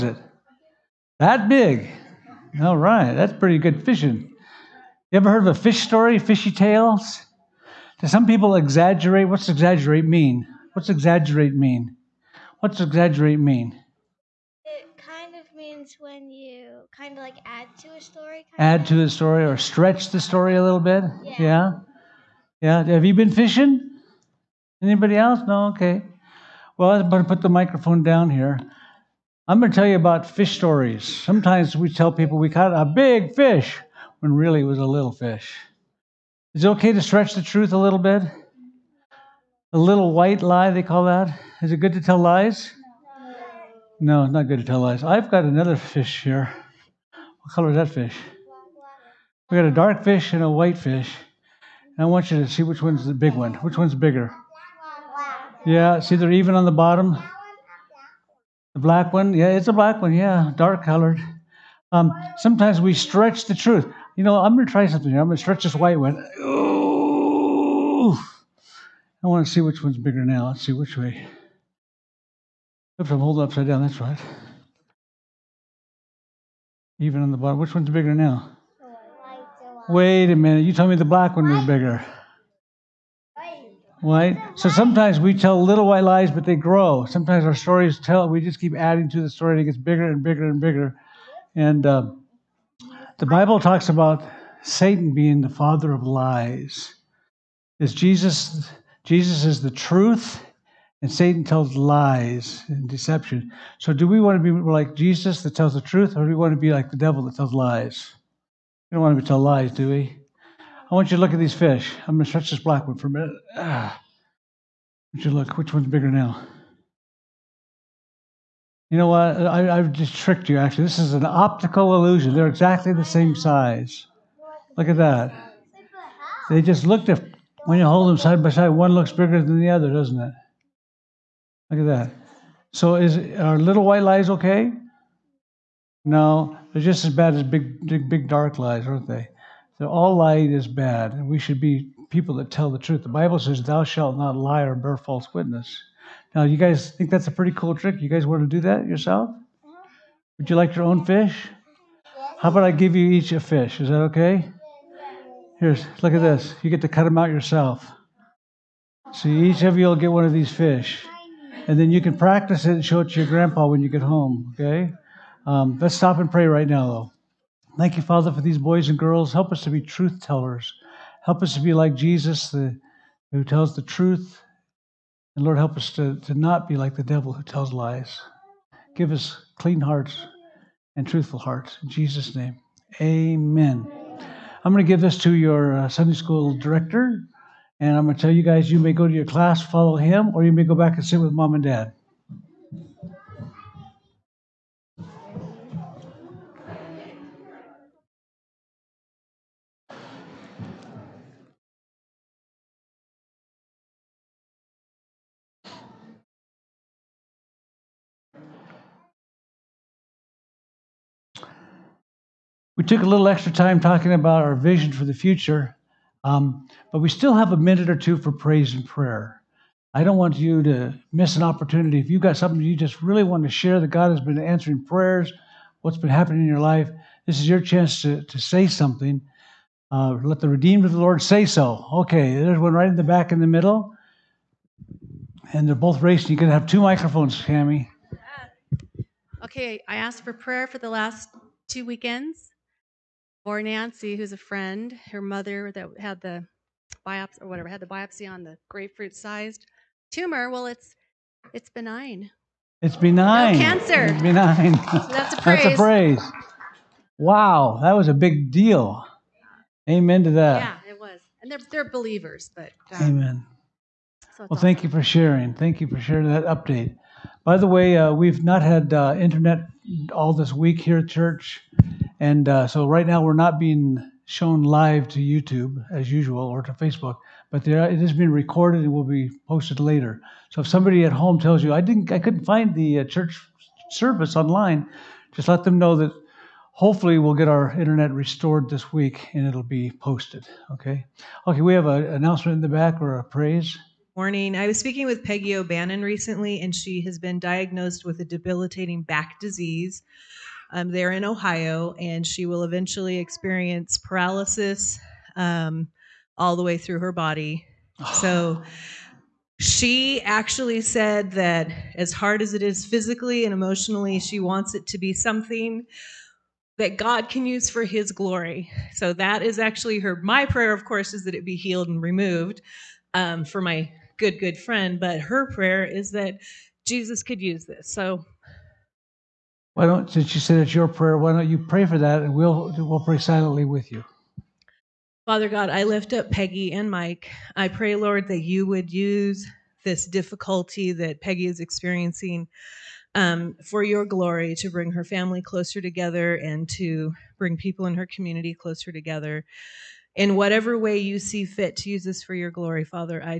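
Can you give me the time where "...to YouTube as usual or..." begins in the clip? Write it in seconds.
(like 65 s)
275 s.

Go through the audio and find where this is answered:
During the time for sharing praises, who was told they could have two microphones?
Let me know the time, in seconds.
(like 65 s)
237 s.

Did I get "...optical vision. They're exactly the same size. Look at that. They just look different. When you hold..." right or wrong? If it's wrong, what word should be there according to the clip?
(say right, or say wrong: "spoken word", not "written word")
wrong: "illusion", not "vision".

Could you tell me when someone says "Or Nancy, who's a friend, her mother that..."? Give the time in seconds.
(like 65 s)
243 s.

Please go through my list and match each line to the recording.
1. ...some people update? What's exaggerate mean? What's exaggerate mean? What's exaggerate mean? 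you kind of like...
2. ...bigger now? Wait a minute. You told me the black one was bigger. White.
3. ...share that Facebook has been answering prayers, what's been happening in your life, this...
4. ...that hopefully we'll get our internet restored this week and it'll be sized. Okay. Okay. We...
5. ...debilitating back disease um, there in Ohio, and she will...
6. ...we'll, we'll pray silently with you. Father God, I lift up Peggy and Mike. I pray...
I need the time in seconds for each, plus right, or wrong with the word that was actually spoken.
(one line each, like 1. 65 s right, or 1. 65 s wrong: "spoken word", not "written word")
1. 8 s wrong: "exaggerate", not "update"
2. 77 s right
3. 223 s wrong: "God", not "Facebook"
4. 285 s wrong: "posted", not "sized"
5. 298 s right
6. 332 s right.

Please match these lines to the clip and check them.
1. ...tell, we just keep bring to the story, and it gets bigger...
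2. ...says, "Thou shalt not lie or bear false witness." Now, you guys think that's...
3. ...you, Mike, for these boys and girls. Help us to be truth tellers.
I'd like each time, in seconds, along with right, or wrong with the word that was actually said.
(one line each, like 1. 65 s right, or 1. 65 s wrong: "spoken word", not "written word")
1. 87 s wrong: "adding", not "bring"
2. 143 s right
3. 167 s wrong: "Father", not "Mike".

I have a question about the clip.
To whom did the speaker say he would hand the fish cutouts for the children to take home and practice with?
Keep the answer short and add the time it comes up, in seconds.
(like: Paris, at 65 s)
Sunday school director, at 185 s.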